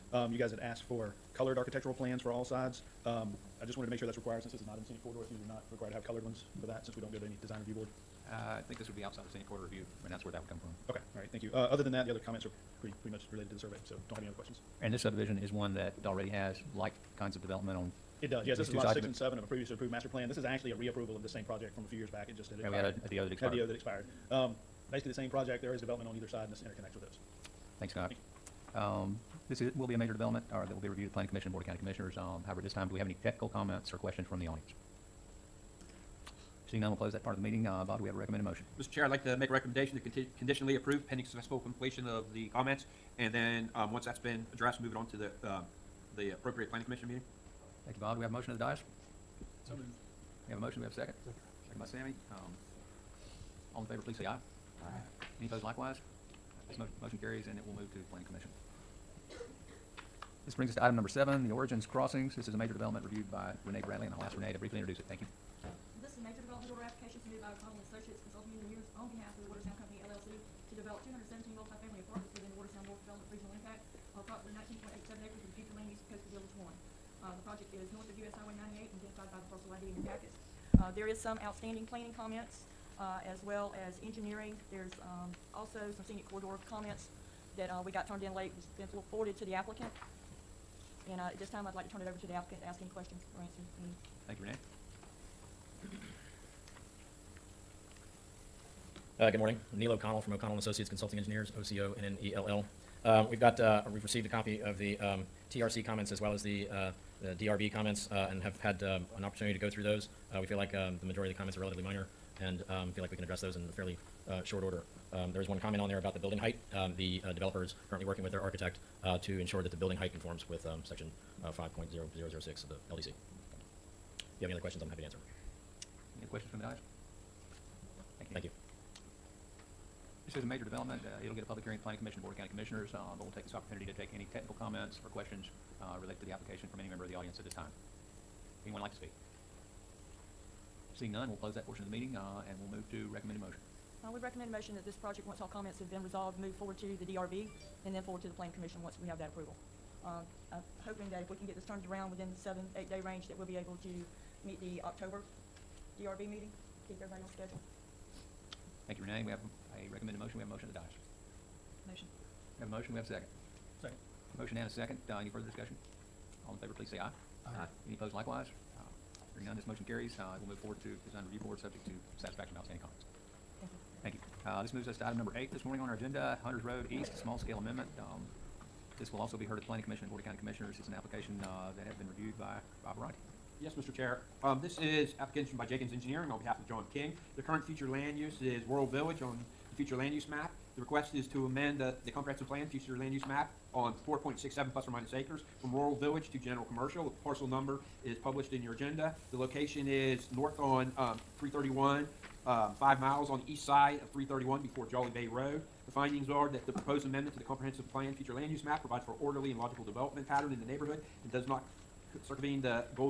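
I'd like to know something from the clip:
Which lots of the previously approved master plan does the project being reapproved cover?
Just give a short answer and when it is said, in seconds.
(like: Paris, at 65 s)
Lots 6 and 7, at 18 s.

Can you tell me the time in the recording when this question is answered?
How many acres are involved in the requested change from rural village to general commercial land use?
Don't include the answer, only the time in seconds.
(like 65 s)
194 s.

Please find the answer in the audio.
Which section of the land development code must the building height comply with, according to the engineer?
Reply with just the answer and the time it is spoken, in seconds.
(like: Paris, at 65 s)
5.0006, at 121 s.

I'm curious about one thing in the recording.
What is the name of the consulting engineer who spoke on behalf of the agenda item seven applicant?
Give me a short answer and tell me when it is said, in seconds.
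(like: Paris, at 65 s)
Neil O'Connell, at 99 s.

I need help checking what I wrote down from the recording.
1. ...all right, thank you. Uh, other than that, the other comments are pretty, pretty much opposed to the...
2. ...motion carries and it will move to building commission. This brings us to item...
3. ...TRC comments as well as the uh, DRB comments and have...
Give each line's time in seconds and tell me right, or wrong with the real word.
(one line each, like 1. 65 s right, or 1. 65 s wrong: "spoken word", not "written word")
1. 11 s wrong: "related", not "opposed"
2. 57 s wrong: "planning", not "building"
3. 105 s right.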